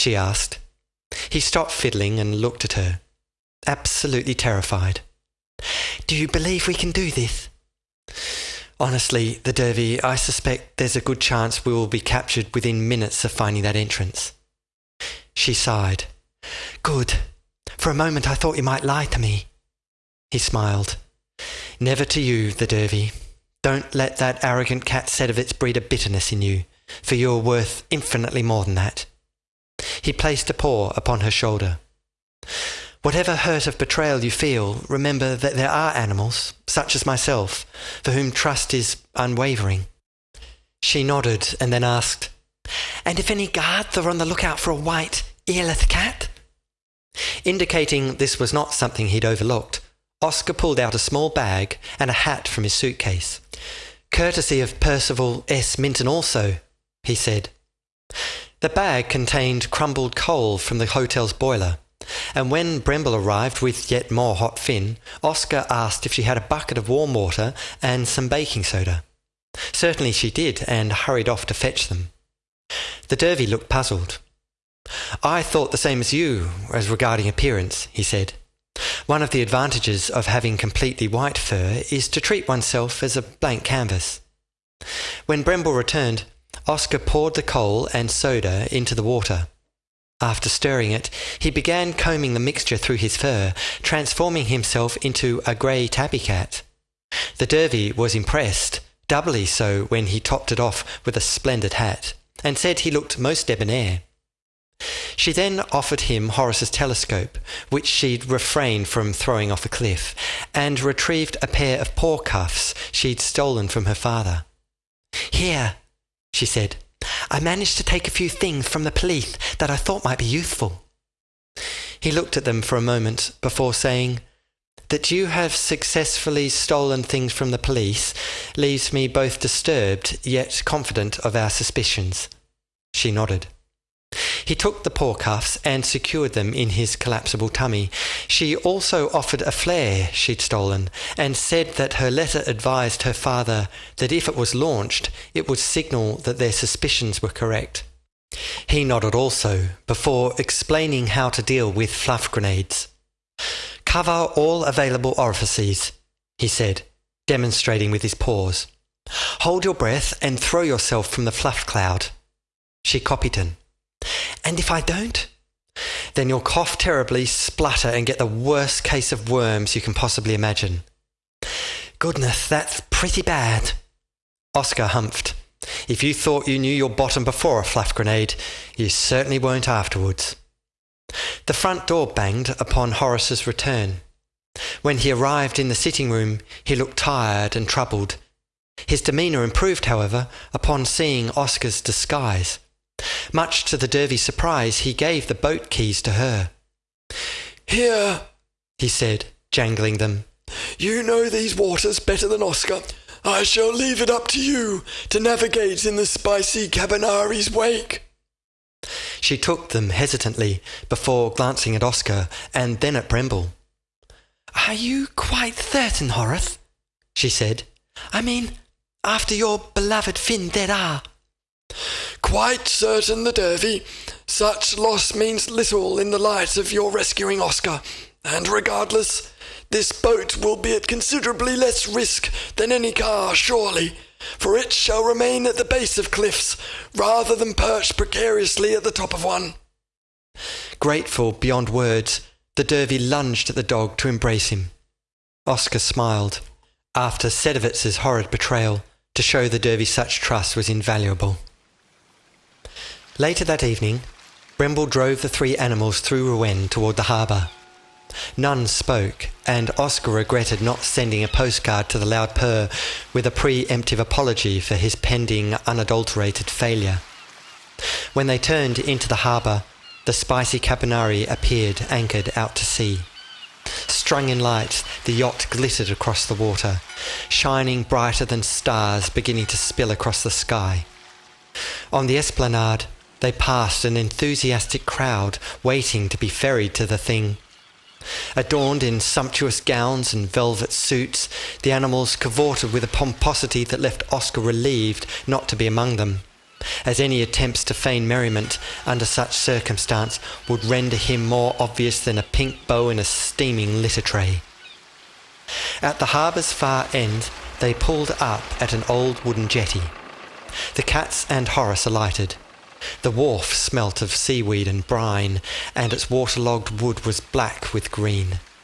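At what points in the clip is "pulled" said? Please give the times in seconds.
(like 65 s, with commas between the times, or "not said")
50 s, 307 s.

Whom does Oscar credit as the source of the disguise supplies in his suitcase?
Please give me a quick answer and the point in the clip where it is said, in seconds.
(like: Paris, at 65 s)
Percival S. Minton, at 54 s.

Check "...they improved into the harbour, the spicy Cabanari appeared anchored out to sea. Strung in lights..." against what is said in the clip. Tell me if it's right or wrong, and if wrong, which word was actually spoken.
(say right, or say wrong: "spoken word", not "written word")
wrong: "turned", not "improved".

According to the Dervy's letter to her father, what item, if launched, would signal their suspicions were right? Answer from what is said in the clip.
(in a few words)
a flare.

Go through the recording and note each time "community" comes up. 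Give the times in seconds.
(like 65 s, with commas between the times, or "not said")
not said.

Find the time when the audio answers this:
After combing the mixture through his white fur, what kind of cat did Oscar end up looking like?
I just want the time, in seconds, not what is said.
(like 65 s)
95 s.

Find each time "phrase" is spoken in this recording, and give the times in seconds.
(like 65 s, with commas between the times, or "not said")
not said.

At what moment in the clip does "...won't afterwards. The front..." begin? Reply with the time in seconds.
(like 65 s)
179 s.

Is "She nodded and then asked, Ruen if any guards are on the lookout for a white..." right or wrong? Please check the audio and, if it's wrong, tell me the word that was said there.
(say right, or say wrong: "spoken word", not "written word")
wrong: "And", not "Ruen".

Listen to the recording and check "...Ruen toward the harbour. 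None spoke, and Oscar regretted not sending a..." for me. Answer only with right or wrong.
right.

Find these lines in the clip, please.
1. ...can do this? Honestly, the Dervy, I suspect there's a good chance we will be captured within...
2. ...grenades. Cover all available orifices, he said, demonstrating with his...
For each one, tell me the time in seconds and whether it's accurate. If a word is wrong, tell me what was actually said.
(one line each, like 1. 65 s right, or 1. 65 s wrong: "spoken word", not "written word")
1. 6 s right
2. 152 s right.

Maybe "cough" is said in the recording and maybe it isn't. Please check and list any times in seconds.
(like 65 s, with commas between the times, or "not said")
166 s.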